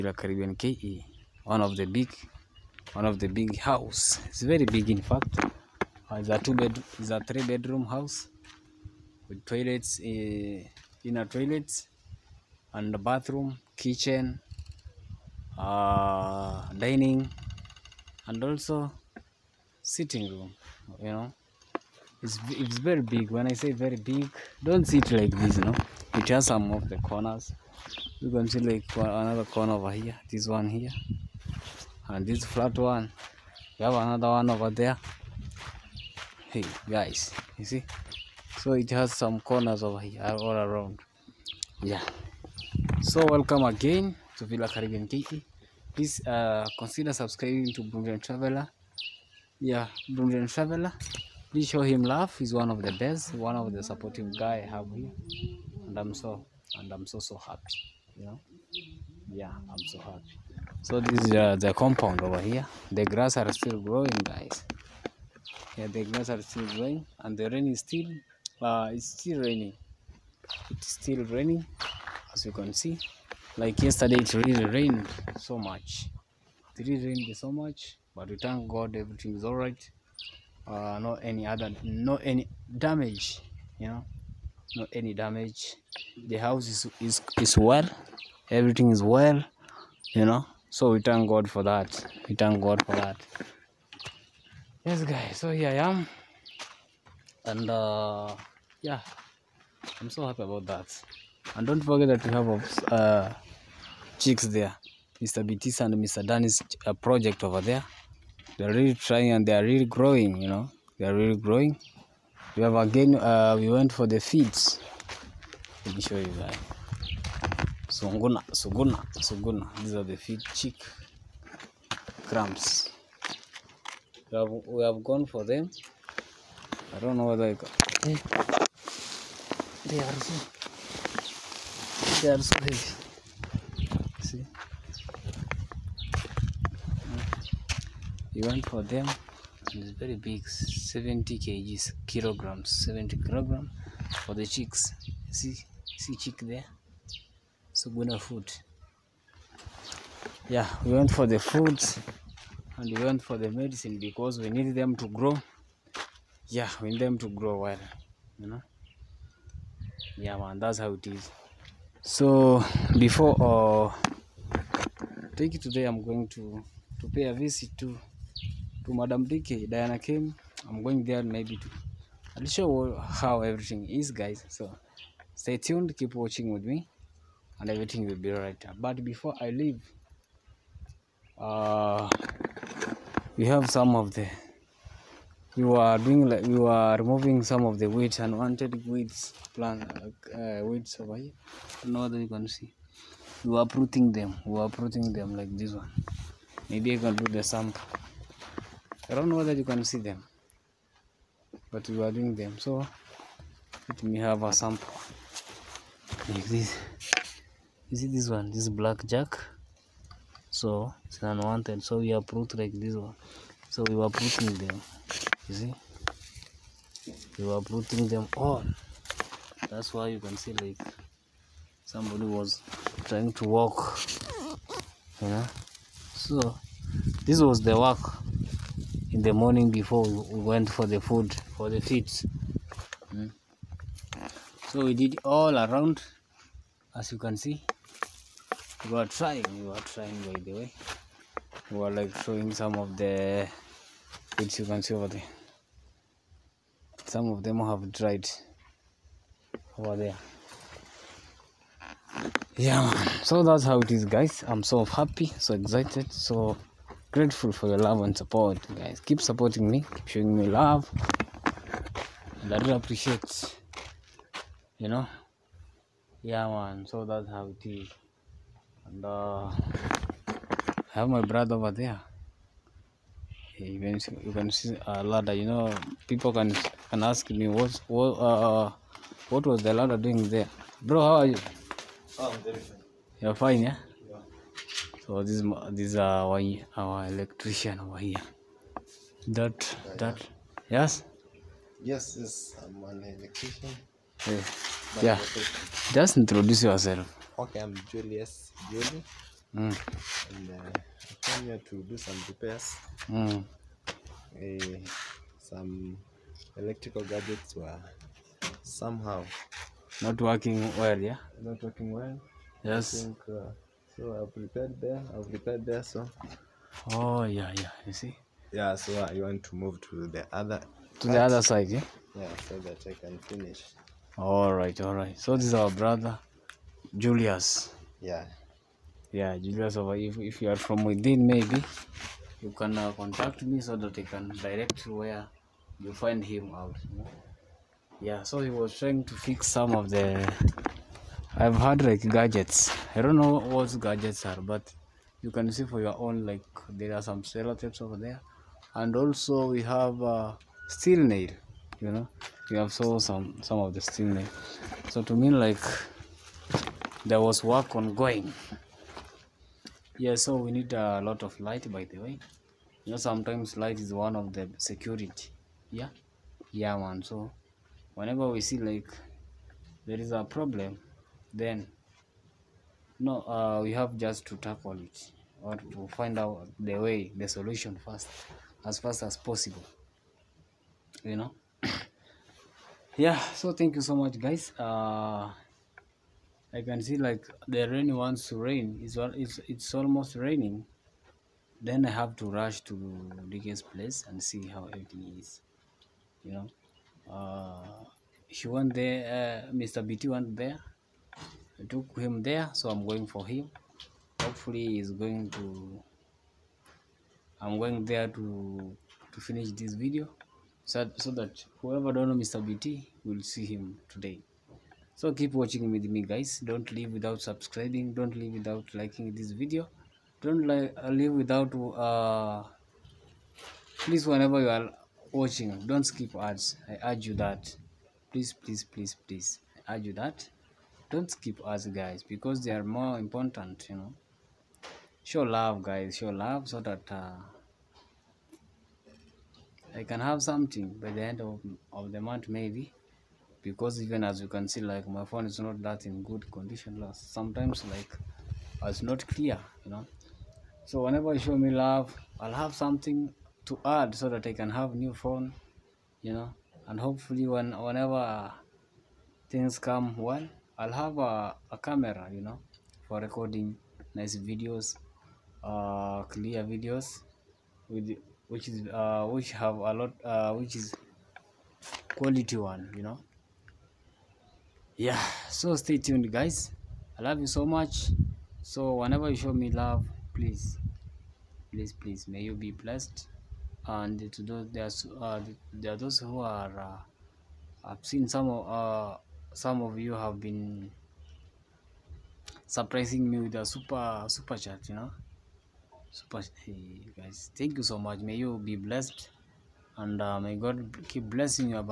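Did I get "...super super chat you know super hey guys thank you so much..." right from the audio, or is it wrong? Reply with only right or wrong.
right.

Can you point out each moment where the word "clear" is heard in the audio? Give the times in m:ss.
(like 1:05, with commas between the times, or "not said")
7:29, 7:46.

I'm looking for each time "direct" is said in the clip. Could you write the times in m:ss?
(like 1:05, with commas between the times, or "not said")
5:34.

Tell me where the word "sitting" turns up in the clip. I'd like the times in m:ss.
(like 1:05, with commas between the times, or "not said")
0:19.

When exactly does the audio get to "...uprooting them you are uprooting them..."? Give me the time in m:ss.
3:13.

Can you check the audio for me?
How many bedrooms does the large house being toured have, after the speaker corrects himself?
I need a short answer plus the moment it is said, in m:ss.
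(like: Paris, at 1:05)
3, at 0:07.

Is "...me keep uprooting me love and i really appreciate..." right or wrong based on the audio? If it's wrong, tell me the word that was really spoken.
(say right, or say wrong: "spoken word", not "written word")
wrong: "showing", not "uprooting".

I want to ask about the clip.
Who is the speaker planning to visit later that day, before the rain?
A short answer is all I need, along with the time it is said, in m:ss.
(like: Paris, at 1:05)
Diana Kemi, at 2:49.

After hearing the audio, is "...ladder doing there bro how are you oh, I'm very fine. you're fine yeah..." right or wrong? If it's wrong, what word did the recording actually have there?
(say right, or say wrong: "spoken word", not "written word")
right.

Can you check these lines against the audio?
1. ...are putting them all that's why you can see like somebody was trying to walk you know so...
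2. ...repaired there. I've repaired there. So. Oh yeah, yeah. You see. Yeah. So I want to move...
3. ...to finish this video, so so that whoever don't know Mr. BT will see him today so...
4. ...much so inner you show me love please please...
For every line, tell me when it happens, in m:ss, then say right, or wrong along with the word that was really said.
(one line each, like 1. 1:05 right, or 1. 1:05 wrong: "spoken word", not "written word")
1. 3:37 right
2. 5:14 right
3. 6:49 right
4. 7:57 wrong: "whenever", not "inner".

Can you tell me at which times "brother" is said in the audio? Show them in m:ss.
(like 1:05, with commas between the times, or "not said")
4:31, 5:25.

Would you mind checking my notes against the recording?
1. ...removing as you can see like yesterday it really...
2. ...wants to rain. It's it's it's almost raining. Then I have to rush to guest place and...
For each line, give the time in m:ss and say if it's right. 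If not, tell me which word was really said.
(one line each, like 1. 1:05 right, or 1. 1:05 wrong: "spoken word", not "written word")
1. 1:11 wrong: "raining", not "removing"
2. 6:27 right.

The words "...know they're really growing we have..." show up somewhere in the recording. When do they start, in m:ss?
1:50.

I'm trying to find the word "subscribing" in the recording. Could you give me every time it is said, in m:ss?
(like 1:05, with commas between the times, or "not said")
0:47, 6:57.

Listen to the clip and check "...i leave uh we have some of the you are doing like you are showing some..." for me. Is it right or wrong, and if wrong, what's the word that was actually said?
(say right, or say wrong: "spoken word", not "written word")
wrong: "removing", not "showing".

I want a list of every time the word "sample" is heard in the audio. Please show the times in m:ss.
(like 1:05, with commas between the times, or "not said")
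3:17, 3:24.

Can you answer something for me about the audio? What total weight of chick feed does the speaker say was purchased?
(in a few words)
70 kg.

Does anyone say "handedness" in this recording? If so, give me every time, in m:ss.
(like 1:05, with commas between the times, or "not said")
not said.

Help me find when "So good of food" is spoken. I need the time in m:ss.
2:27.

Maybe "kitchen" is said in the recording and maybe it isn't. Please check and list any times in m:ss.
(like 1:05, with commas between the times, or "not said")
0:13.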